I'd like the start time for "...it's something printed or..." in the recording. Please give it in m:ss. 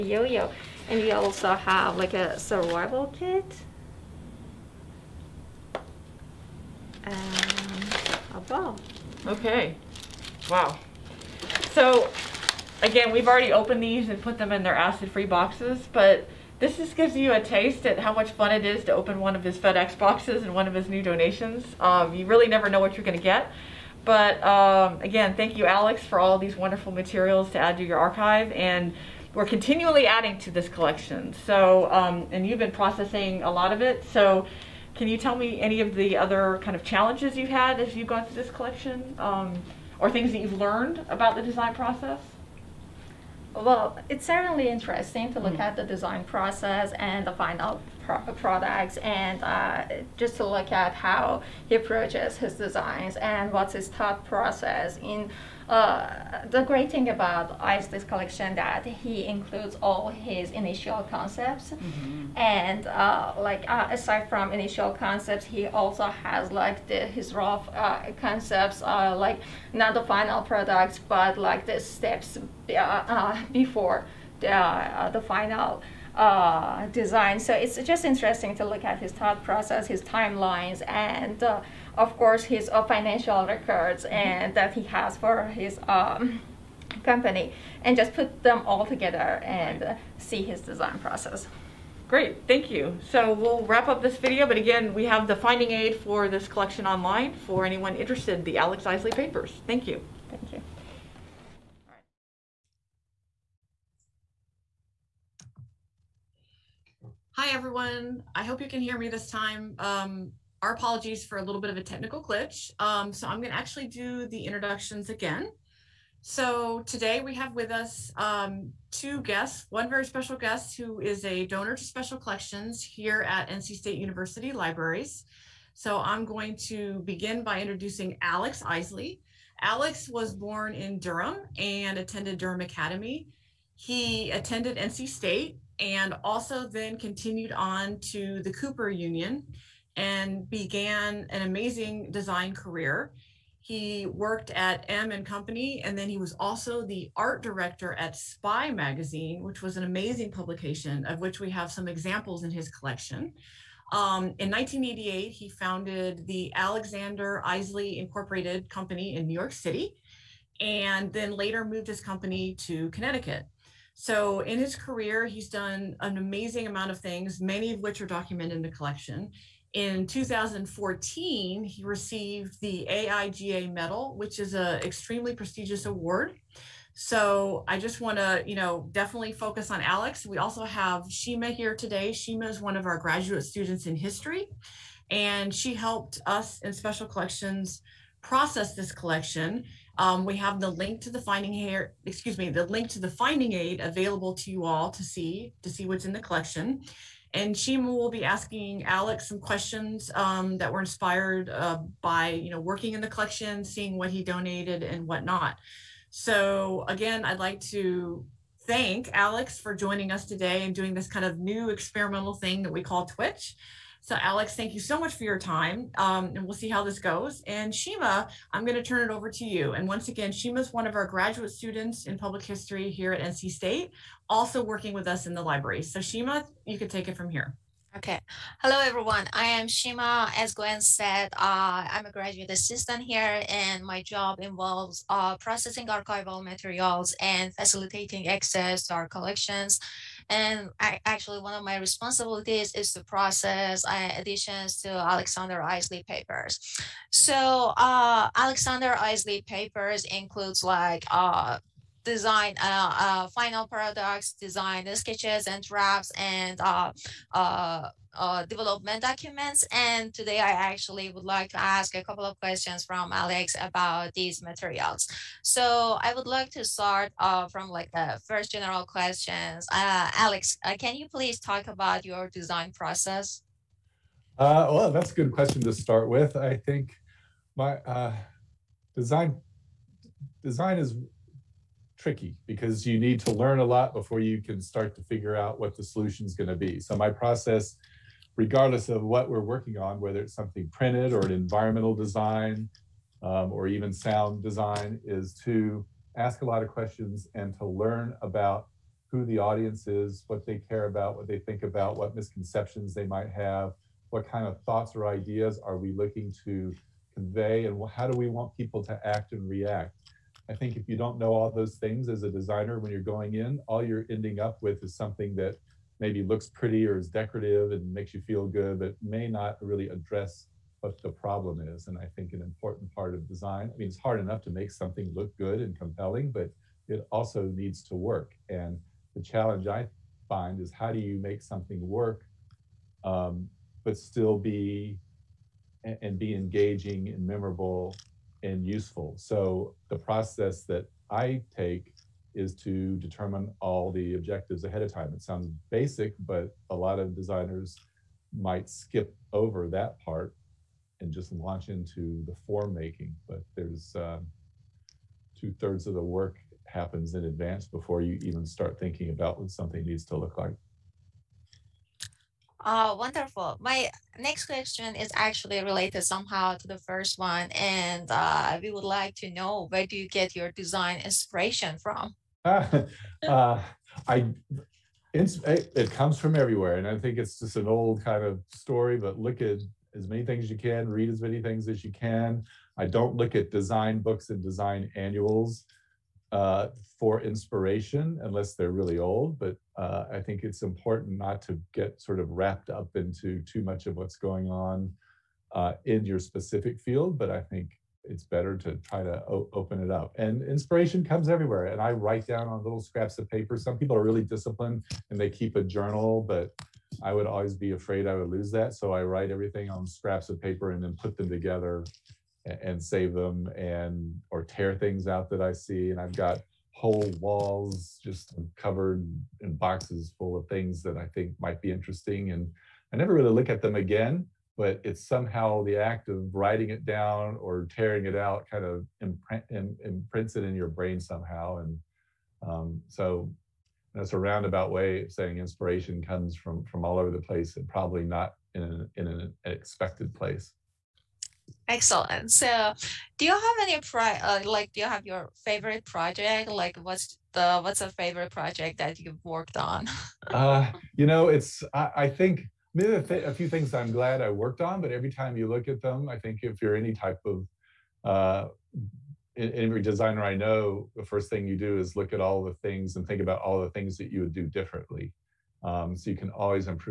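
4:50.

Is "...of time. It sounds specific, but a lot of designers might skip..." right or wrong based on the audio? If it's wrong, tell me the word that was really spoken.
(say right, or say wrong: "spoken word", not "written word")
wrong: "basic", not "specific".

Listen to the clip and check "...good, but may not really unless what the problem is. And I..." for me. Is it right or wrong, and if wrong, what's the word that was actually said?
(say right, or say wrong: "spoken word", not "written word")
wrong: "address", not "unless".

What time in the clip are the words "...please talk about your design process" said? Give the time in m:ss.
4:31.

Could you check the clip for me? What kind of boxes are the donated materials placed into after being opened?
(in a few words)
acid-free boxes.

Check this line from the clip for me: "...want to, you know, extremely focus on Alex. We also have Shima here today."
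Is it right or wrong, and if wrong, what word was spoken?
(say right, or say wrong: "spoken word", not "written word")
wrong: "definitely", not "extremely".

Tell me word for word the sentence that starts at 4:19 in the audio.
And today I actually would like to ask a couple of questions from Alex about these materials.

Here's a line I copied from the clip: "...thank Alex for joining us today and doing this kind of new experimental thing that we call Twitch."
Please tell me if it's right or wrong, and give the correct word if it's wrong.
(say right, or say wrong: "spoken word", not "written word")
right.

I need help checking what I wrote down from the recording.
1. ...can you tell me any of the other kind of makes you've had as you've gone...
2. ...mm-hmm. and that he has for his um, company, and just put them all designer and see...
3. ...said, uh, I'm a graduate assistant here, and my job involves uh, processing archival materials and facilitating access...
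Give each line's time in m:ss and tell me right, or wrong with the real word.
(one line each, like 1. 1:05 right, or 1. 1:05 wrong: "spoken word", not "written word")
1. 0:34 wrong: "challenges", not "makes"
2. 1:24 wrong: "together", not "designer"
3. 3:50 right.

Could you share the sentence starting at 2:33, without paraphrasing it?
Um, in 1988, he founded the Alexander Isley Incorporated Company in New York City, and then later moved his company to Connecticut.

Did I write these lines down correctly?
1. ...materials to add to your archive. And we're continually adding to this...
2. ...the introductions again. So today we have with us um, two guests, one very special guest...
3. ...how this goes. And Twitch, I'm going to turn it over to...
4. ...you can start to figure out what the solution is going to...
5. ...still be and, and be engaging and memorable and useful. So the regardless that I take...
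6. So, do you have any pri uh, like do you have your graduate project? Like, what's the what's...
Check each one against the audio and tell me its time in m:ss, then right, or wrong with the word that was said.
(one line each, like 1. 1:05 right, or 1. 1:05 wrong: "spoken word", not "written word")
1. 0:26 right
2. 1:54 right
3. 3:36 wrong: "Shima", not "Twitch"
4. 4:44 right
5. 5:33 wrong: "process", not "regardless"
6. 7:22 wrong: "favorite", not "graduate".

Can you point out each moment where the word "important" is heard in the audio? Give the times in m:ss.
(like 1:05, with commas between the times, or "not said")
5:22, 6:30.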